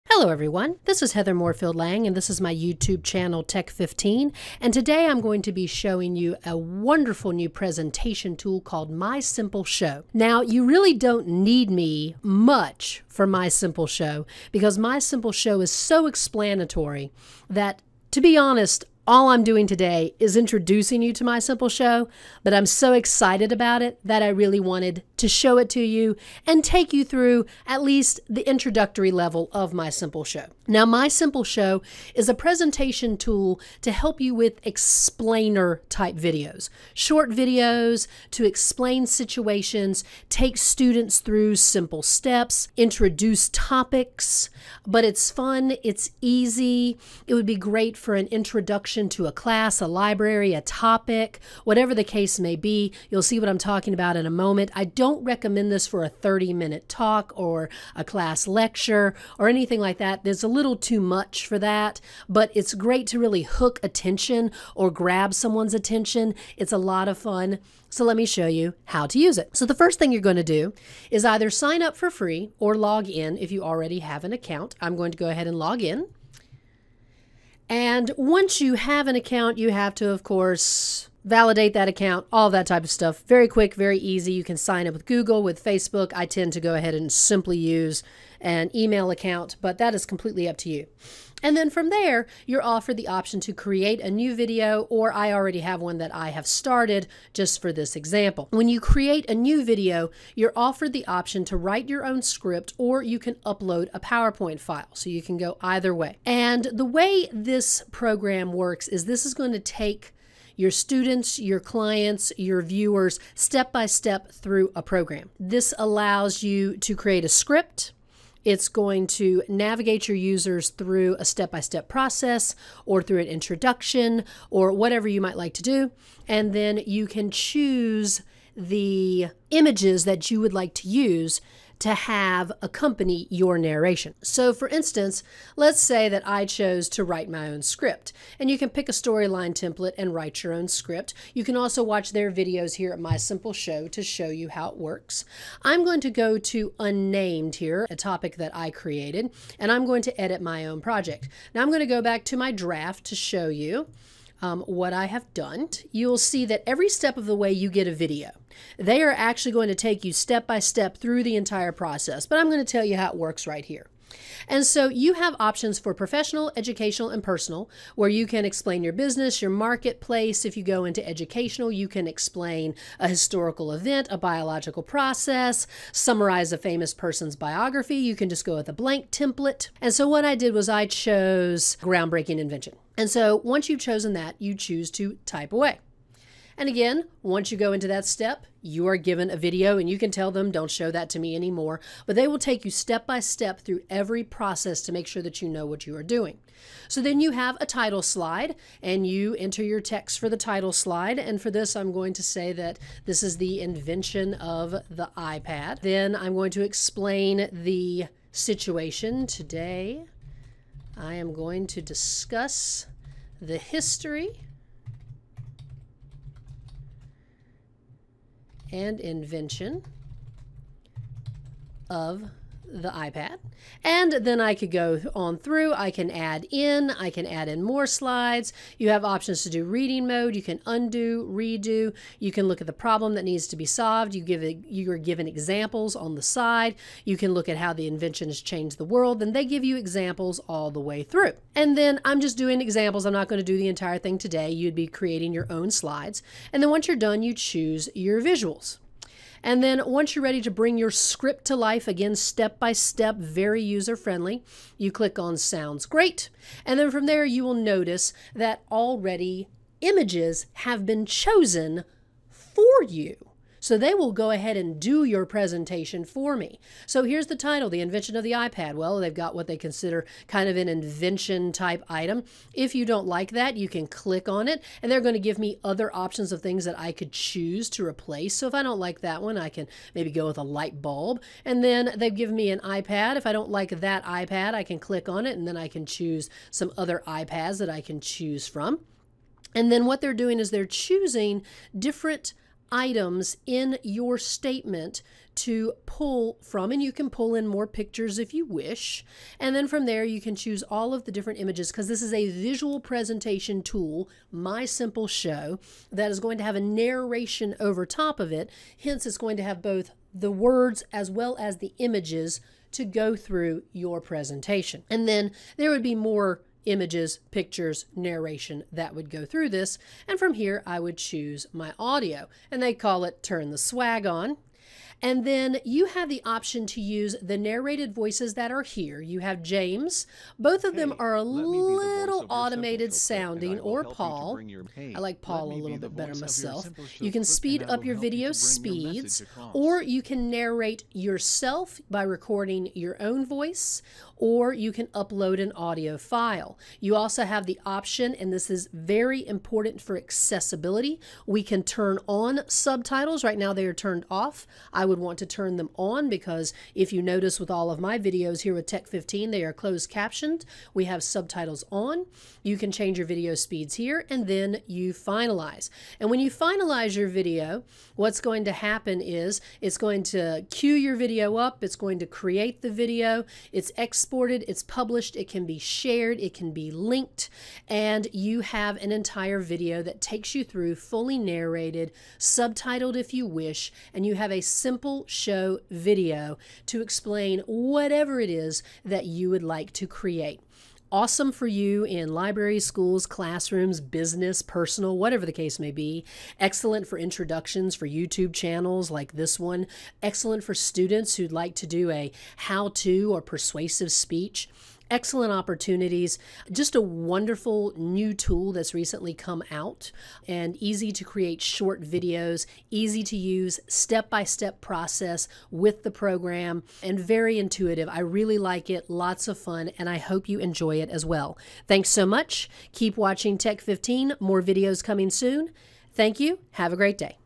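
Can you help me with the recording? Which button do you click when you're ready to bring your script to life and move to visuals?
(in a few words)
Sounds Great.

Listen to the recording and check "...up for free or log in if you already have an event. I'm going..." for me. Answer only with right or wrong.
wrong.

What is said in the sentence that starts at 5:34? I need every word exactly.
I like Paul a little bit better myself.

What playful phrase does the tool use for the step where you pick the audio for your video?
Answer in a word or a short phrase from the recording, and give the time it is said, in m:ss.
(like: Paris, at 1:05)
Turn the Swag On, at 5:23.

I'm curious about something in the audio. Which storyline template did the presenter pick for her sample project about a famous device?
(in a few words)
groundbreaking invention.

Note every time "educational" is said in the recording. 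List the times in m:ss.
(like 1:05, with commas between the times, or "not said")
2:46, 2:51.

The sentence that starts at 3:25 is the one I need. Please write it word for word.
Then I'm going to explain the situation today.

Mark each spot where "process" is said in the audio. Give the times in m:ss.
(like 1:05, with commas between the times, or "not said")
2:01, 2:41, 2:54, 3:14, 6:54.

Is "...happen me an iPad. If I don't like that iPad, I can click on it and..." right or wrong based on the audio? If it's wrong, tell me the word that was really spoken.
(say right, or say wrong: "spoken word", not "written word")
wrong: "given", not "happen".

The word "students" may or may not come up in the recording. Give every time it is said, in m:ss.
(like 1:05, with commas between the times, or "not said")
0:40, 1:50, 6:40.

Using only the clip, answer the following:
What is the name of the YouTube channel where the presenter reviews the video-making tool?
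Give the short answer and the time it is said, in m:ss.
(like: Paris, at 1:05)
Tech15, at 0:03.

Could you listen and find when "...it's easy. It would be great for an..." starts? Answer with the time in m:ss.
0:45.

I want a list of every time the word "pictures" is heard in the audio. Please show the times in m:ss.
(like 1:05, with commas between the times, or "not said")
4:57, 5:17.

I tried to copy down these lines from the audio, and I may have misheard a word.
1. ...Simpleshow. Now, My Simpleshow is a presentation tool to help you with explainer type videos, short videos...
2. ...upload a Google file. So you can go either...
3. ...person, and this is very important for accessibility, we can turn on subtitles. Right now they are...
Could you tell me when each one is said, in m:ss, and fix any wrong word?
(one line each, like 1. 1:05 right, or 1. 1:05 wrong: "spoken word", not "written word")
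1. 0:29 right
2. 1:43 wrong: "PowerPoint", not "Google"
3. 5:47 wrong: "option", not "person".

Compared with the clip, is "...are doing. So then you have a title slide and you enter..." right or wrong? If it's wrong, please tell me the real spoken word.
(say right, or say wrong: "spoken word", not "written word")
right.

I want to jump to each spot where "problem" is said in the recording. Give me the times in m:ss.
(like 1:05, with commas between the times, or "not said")
3:52.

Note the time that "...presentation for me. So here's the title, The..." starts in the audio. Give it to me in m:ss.
4:25.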